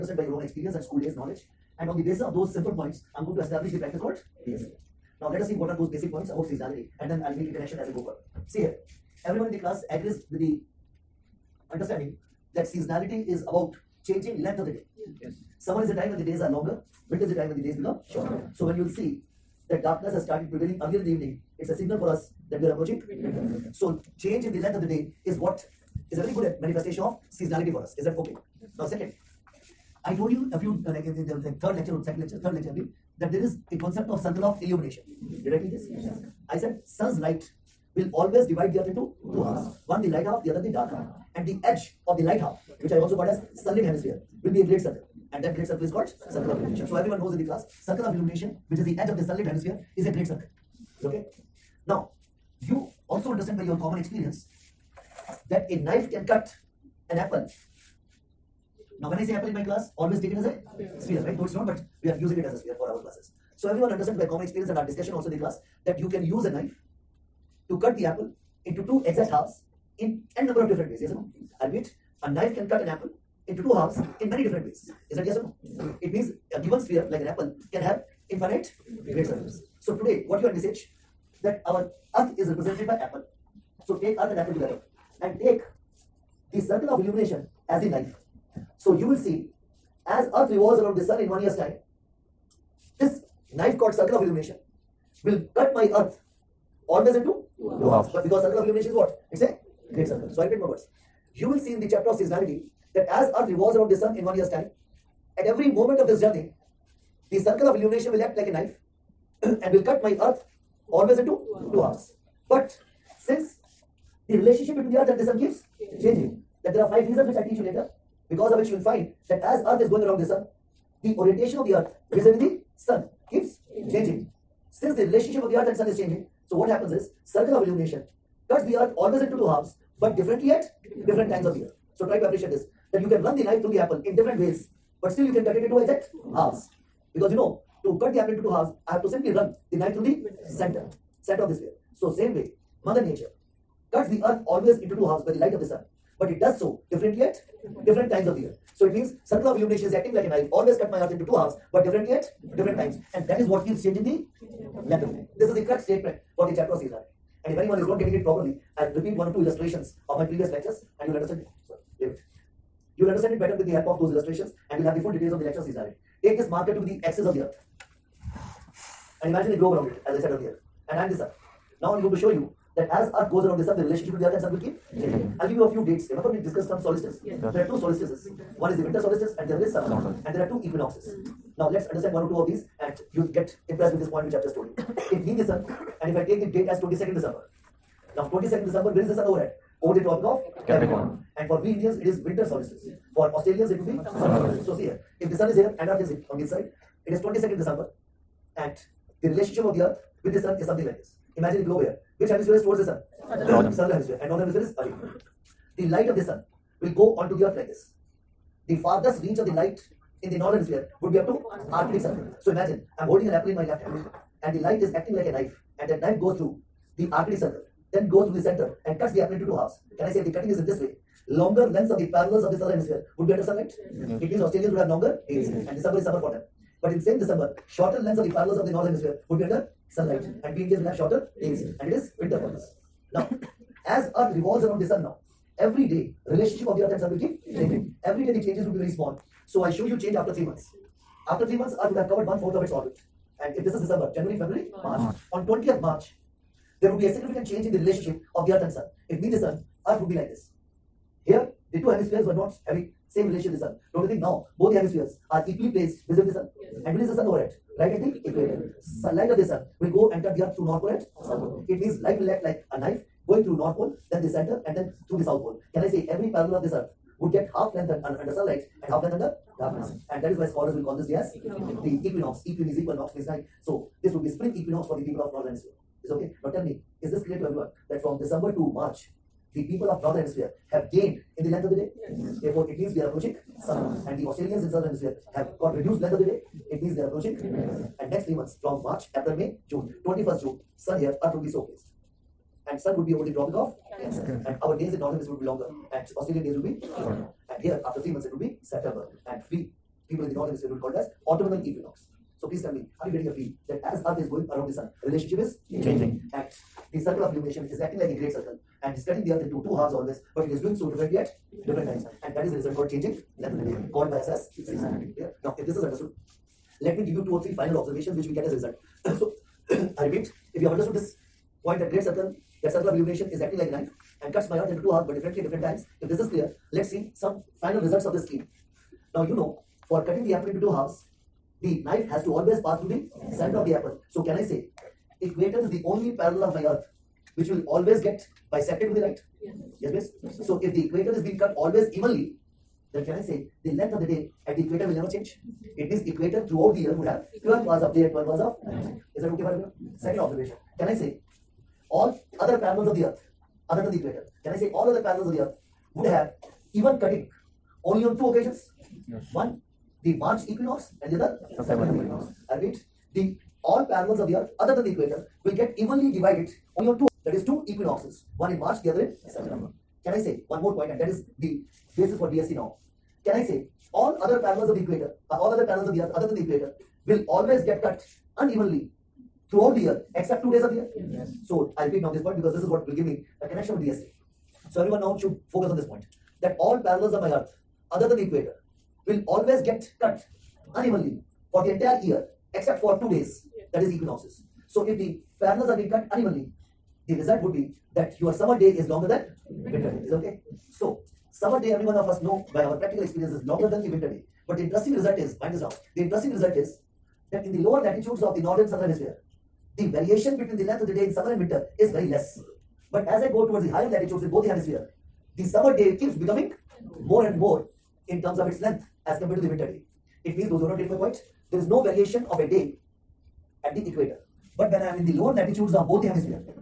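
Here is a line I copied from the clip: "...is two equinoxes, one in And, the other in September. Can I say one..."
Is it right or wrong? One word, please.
wrong.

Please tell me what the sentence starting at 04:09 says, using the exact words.
If me the Sun, Earth would be like this.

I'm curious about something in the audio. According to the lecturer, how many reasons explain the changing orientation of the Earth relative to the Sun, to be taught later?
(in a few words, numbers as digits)
5.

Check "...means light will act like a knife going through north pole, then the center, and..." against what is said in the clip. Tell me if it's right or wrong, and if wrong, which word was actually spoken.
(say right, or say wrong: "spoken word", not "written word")
right.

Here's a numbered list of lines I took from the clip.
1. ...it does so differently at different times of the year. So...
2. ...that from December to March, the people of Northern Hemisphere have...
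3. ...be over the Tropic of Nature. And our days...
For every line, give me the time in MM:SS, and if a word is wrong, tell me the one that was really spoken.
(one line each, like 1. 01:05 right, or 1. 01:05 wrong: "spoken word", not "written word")
1. 02:26 right
2. 04:37 right
3. 04:53 wrong: "Cancer", not "Nature".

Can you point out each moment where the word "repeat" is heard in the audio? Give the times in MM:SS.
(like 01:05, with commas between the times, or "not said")
01:40, 02:38, 05:20, 06:02, 06:21.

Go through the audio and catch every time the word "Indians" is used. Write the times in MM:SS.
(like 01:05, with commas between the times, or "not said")
03:11, 03:50.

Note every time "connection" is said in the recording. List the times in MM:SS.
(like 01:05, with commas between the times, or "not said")
00:07, 06:23.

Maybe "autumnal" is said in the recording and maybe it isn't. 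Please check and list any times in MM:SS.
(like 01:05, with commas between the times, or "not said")
05:01.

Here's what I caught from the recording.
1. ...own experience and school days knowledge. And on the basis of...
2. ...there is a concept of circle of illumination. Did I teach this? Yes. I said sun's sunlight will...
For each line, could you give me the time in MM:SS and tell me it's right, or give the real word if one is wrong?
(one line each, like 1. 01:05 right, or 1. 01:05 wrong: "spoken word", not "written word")
1. 00:00 right
2. 00:33 wrong: "light", not "sunlight".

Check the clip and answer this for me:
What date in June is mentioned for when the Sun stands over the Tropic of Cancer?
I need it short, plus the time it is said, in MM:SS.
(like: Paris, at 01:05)
21st June, at 04:50.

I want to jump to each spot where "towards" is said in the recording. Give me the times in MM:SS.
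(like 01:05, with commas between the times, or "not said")
03:22, 06:53.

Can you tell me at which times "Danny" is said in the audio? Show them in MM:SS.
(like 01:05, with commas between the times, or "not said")
not said.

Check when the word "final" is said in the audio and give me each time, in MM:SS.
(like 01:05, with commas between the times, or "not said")
05:17, 05:27.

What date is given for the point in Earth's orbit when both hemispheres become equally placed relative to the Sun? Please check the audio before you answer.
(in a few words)
20th March.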